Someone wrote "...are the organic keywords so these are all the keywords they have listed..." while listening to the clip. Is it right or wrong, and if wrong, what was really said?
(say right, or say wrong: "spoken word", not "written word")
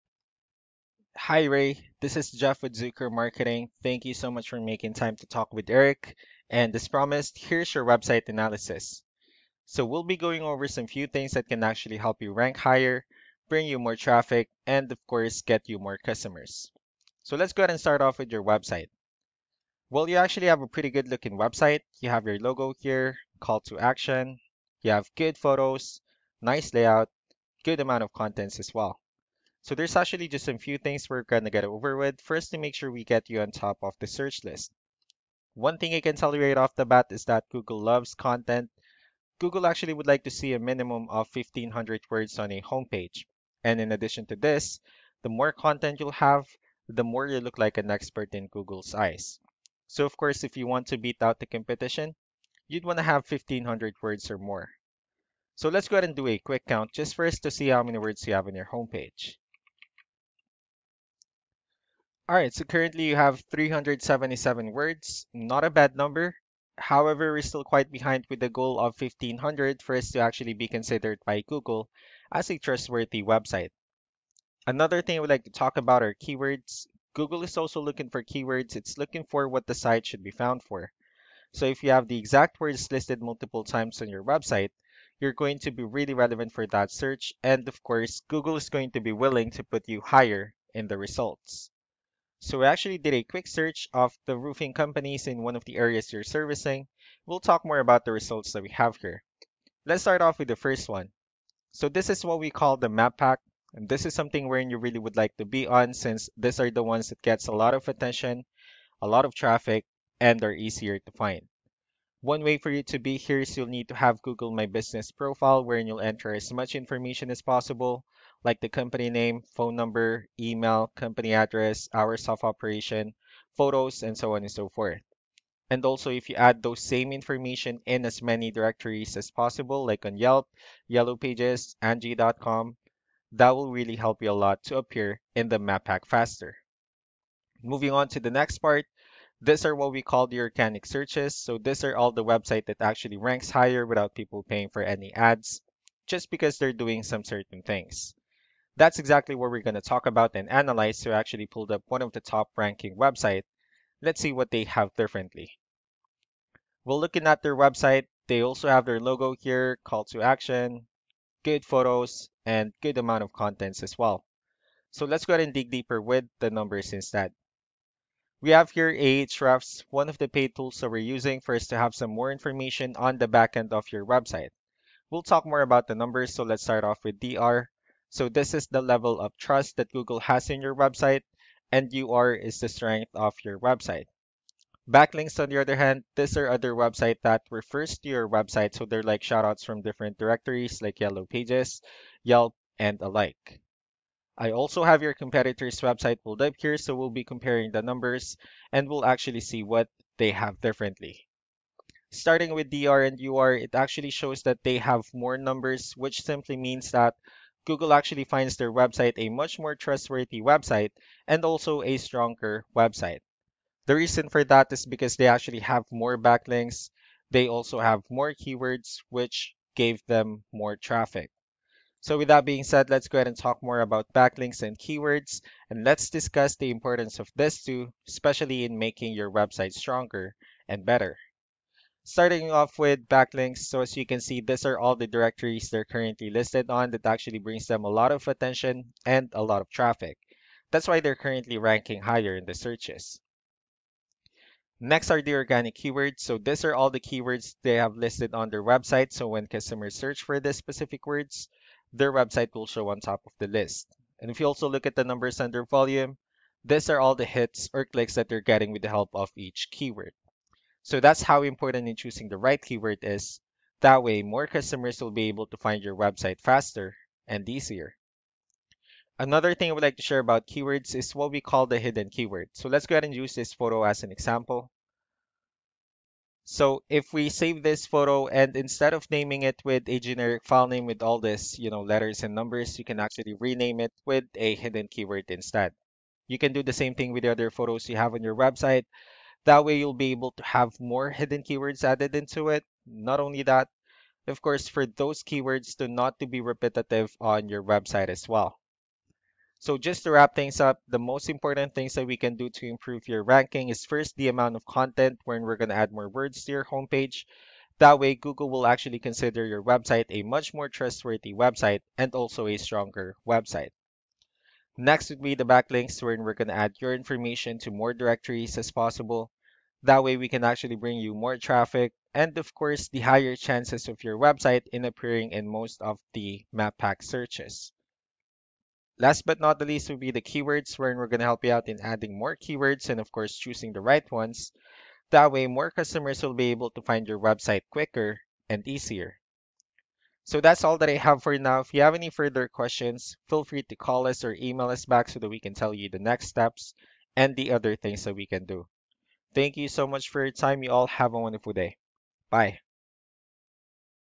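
right.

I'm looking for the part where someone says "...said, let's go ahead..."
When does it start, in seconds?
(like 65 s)
222 s.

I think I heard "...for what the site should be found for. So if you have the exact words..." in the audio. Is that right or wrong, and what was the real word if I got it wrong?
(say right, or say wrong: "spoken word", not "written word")
right.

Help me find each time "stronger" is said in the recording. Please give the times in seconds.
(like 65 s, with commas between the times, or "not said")
211 s, 229 s, 312 s.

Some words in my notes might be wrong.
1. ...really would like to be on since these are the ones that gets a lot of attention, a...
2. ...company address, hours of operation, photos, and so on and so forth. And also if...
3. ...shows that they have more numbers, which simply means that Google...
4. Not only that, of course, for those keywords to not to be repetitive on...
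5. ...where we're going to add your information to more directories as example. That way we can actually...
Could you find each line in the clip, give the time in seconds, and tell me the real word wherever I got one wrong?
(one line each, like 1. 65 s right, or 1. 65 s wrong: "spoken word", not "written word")
1. 104 s right
2. 120 s right
3. 204 s right
4. 292 s right
5. 316 s wrong: "possible", not "example".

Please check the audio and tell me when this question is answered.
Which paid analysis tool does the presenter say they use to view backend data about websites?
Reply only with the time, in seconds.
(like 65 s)
168 s.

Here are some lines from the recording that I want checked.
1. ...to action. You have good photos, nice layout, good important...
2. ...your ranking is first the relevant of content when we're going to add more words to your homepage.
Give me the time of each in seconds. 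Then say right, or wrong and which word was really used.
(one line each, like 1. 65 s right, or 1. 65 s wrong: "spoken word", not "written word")
1. 23 s wrong: "amount", not "important"
2. 303 s wrong: "amount", not "relevant".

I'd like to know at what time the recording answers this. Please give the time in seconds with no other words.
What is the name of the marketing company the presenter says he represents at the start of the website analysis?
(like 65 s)
2 s.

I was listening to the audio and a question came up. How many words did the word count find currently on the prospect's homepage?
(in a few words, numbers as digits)
377.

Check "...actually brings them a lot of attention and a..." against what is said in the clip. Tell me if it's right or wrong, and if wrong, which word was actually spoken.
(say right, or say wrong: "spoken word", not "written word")
right.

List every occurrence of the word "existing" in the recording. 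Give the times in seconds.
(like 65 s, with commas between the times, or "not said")
not said.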